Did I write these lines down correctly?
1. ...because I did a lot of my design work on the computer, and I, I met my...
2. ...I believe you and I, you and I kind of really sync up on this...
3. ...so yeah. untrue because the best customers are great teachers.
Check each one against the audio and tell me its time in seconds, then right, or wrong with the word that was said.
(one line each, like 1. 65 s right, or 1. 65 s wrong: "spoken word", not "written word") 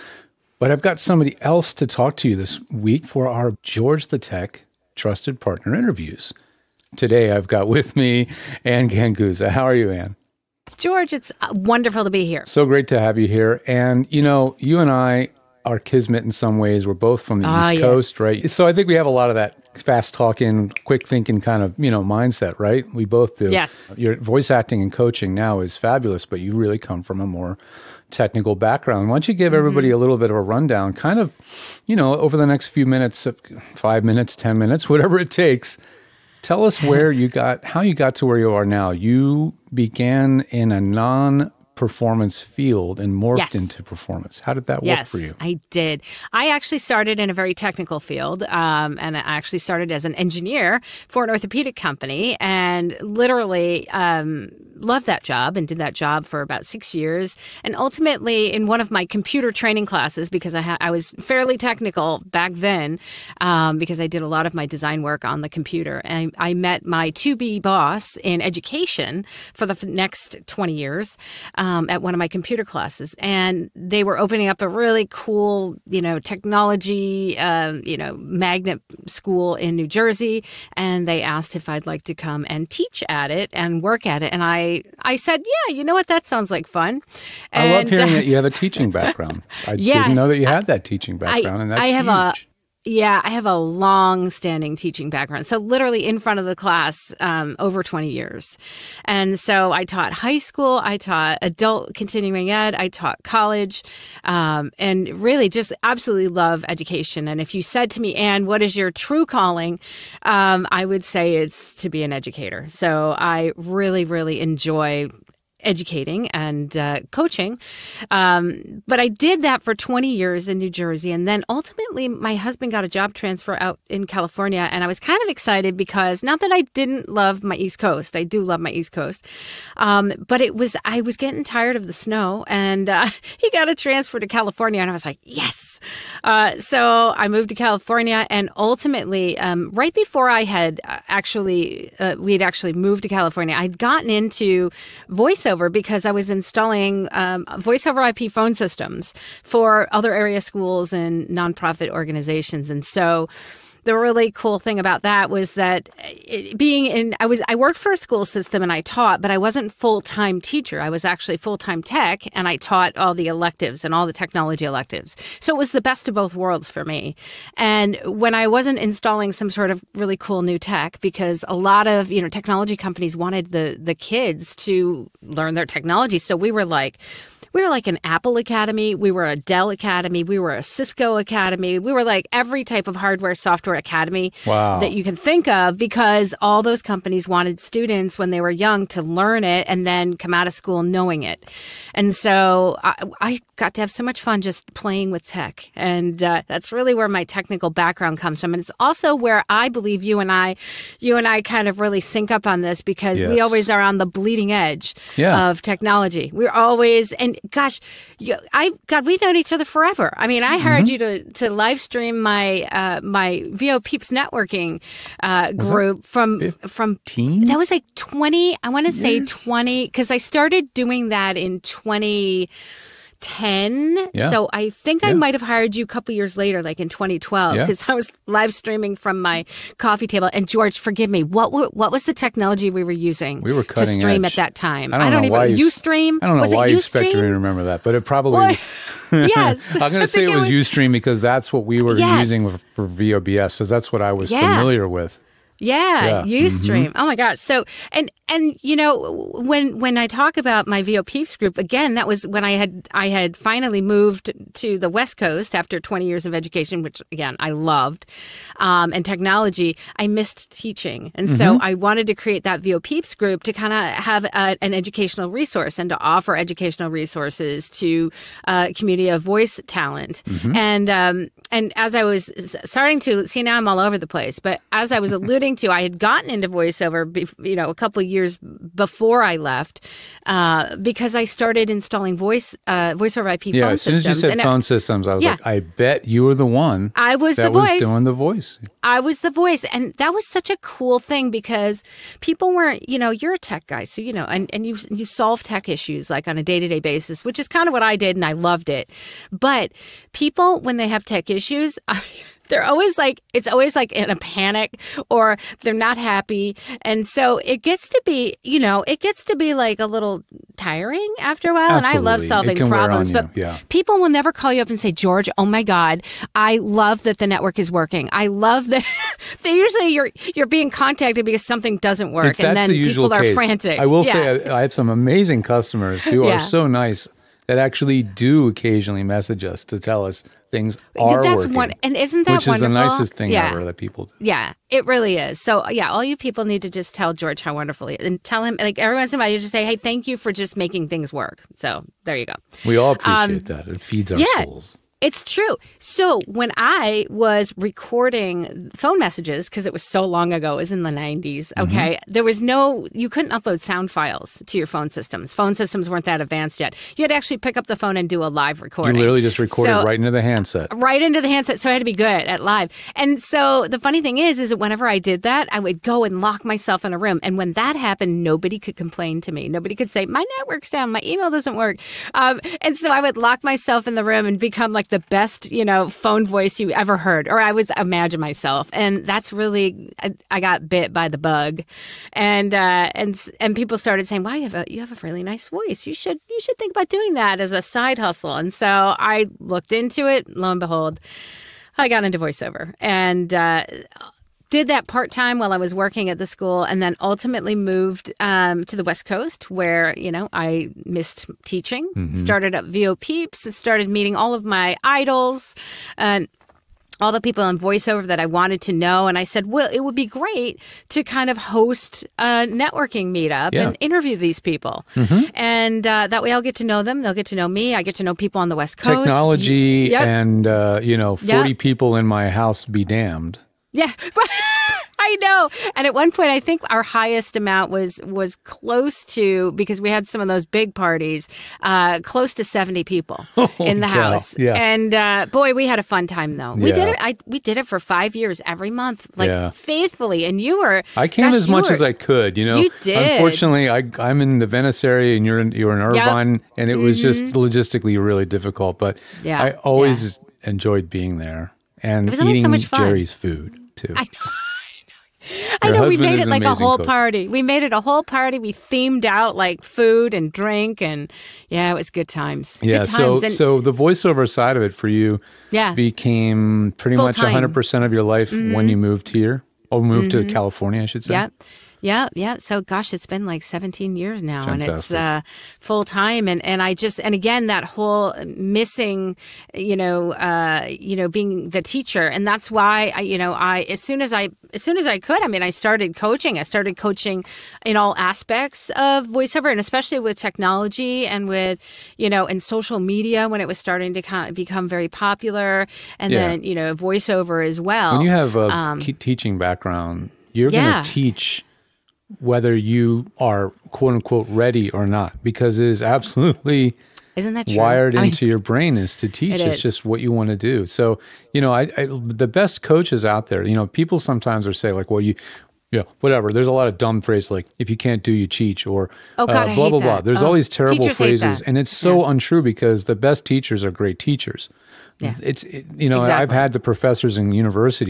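1. 63 s right
2. 199 s right
3. 521 s wrong: "teachers", not "customers".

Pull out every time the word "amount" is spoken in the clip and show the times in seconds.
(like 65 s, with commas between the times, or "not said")
427 s.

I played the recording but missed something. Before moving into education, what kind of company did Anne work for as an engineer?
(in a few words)
Orthopedic company.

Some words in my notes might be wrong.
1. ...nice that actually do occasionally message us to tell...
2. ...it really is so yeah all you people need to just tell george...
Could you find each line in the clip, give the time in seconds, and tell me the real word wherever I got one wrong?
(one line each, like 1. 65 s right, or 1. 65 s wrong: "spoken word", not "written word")
1. 326 s right
2. 334 s right.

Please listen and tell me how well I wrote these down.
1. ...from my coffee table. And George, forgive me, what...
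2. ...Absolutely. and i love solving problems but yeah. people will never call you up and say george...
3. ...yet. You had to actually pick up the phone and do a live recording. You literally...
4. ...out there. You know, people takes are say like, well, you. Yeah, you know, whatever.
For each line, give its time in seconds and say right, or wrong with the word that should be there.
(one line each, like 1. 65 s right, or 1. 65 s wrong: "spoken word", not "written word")
1. 228 s right
2. 311 s right
3. 356 s right
4. 513 s wrong: "sometimes", not "takes".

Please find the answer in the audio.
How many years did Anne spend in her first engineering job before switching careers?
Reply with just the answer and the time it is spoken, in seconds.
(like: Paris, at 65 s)
6 years, at 56 s.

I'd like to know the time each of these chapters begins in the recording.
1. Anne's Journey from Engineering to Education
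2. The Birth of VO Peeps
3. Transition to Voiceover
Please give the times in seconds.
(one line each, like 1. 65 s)
1. 28 s
2. 246 s
3. 120 s.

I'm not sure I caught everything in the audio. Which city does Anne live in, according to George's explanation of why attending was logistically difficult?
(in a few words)
Irvine.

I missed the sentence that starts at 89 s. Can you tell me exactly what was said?
I yes, didn't know that you had that teaching background, I, and that's I have huge.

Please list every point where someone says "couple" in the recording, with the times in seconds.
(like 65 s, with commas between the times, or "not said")
225 s, 277 s.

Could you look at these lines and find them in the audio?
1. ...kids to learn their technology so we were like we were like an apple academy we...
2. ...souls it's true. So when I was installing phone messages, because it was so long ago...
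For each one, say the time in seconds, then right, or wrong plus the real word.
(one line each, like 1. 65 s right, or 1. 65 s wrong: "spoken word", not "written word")
1. 173 s right
2. 344 s wrong: "recording", not "installing".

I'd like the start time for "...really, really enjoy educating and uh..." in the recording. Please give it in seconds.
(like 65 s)
113 s.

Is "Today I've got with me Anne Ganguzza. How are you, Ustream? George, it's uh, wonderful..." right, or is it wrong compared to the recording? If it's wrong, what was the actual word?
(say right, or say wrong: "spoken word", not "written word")
wrong: "Anne", not "Ustream".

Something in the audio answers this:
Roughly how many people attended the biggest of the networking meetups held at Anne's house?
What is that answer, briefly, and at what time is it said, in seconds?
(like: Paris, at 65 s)
70, at 432 s.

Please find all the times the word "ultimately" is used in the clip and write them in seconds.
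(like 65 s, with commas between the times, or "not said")
57 s, 121 s, 138 s, 396 s.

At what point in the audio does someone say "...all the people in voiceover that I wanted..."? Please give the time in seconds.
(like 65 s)
406 s.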